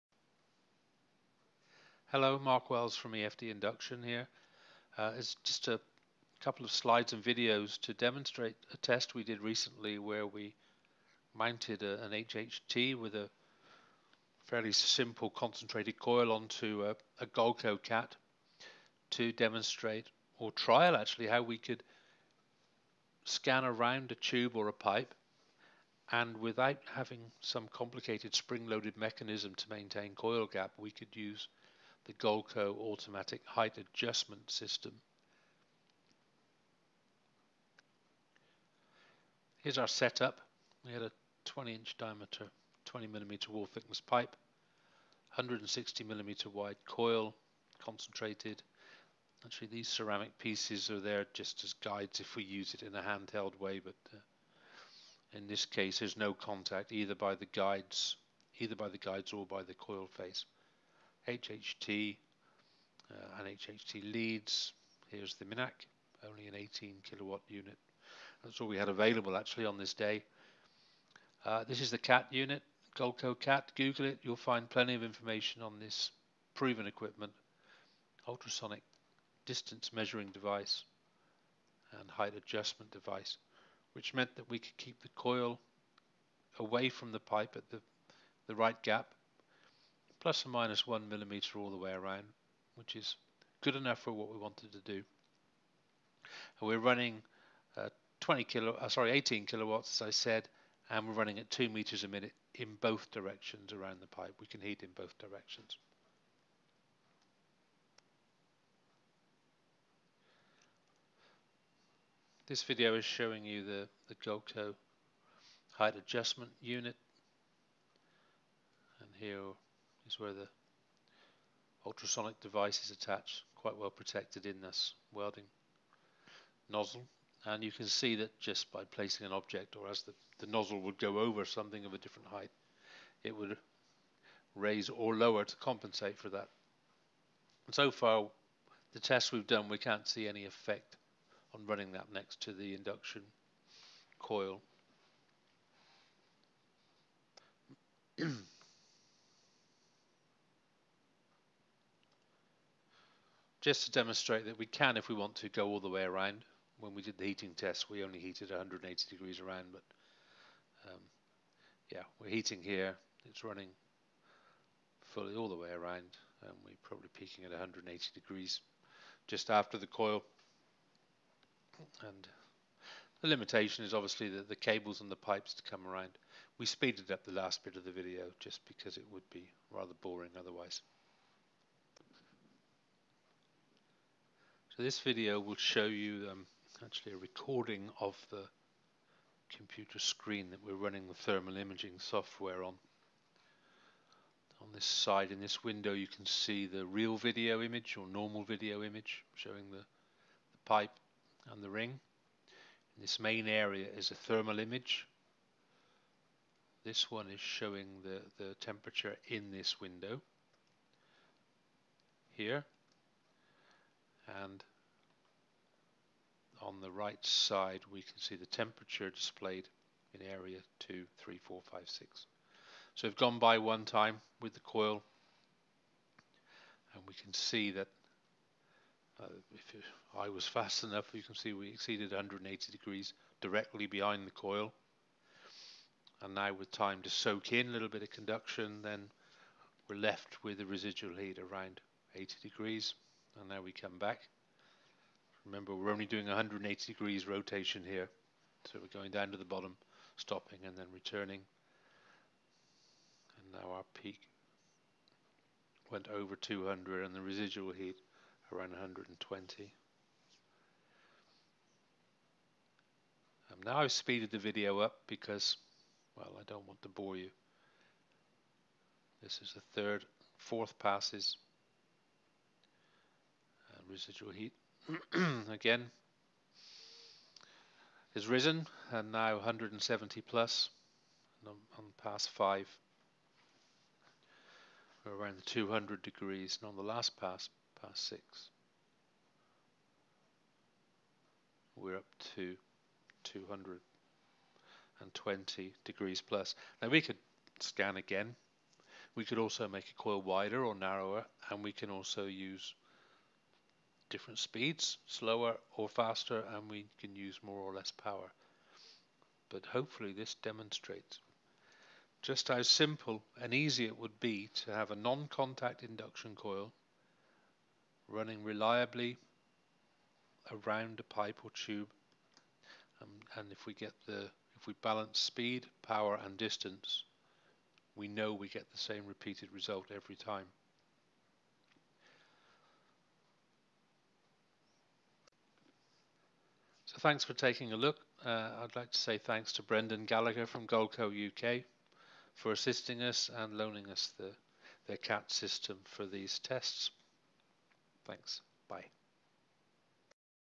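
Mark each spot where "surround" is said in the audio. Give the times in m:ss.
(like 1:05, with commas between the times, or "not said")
not said.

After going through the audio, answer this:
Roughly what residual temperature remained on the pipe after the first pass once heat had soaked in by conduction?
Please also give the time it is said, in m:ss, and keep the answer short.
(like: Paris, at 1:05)
80 degrees, at 4:02.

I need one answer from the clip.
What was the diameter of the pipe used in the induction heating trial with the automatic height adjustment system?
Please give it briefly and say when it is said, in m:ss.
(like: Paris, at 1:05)
20 inch, at 0:41.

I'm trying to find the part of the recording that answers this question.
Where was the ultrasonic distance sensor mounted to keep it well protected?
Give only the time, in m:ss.
2:05.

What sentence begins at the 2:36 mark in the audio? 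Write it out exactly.
When we did the heating test, we only heated 180 degrees around, but um, yeah, we're heating here.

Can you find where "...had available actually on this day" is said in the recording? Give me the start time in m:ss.
1:08.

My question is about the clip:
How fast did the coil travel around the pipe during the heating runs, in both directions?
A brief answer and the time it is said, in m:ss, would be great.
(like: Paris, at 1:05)
2 meters a minute, at 1:41.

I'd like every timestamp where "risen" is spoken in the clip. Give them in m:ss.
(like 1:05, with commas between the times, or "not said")
4:38.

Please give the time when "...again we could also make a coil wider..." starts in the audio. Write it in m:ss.
4:57.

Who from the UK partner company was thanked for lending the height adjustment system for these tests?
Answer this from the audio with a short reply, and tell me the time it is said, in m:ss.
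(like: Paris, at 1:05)
Brendan Gallagher, at 5:39.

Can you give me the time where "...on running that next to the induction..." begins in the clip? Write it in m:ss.
2:21.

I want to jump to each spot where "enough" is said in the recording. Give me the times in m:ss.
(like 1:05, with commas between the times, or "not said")
1:33, 3:50.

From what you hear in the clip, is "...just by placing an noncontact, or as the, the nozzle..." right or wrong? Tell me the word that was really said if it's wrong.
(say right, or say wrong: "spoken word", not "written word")
wrong: "object", not "noncontact".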